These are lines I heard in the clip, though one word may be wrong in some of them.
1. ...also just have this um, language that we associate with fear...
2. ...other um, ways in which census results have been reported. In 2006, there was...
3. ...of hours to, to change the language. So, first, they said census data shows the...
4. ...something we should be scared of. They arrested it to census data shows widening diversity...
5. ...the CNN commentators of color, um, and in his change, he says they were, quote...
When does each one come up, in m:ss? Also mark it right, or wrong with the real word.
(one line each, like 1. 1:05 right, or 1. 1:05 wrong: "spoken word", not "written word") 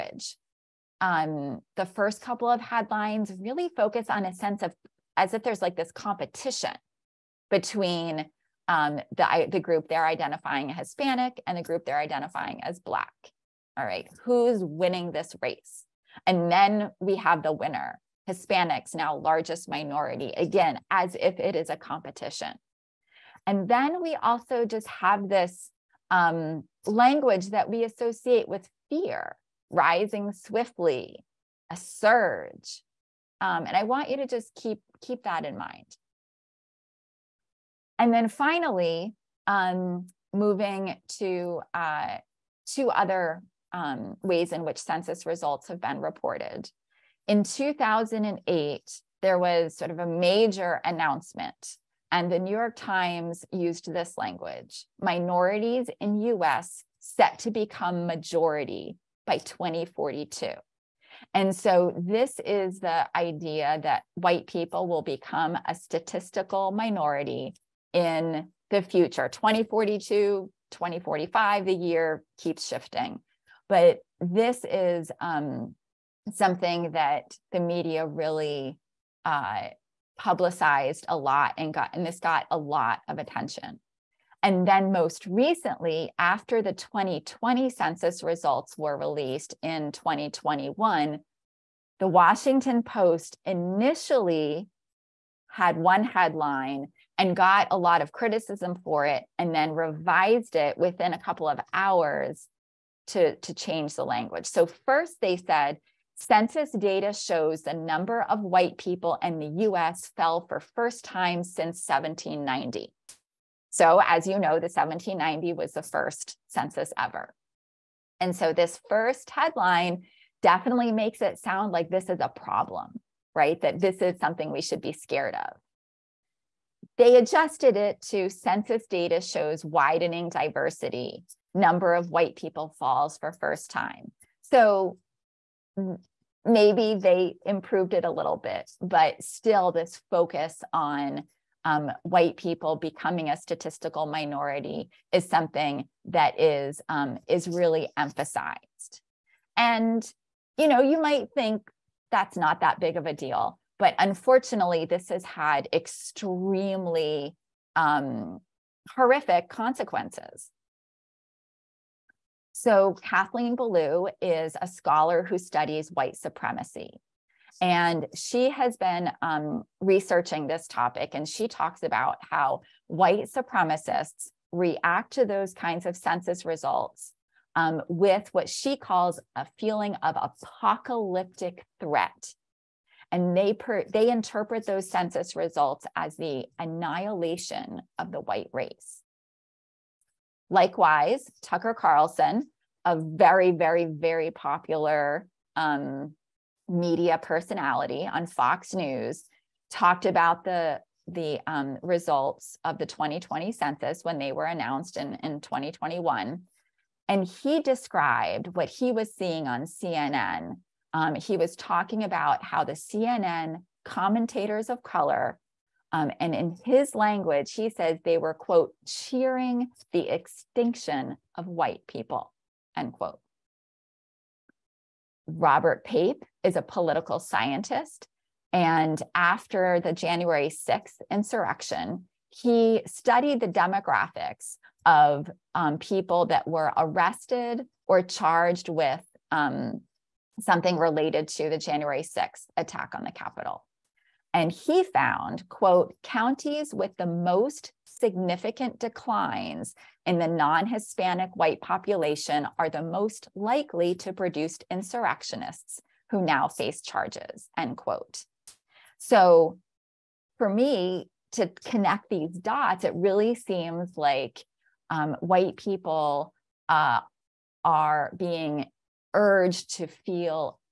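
1. 0:24 right
2. 0:42 wrong: "2008", not "2006"
3. 1:41 right
4. 2:04 wrong: "adjusted", not "arrested"
5. 3:32 wrong: "language", not "change".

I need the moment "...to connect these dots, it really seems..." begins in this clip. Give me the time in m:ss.
4:21.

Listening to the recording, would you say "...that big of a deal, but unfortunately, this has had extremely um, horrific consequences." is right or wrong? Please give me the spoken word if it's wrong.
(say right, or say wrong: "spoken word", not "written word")
right.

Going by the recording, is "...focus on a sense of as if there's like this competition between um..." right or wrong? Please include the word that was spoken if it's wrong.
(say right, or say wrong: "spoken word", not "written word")
right.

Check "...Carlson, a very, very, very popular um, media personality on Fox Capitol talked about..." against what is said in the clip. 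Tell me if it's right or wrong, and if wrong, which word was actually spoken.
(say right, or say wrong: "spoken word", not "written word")
wrong: "News", not "Capitol".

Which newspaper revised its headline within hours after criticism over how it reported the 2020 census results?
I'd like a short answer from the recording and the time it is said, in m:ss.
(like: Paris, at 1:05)
Washington Post, at 1:31.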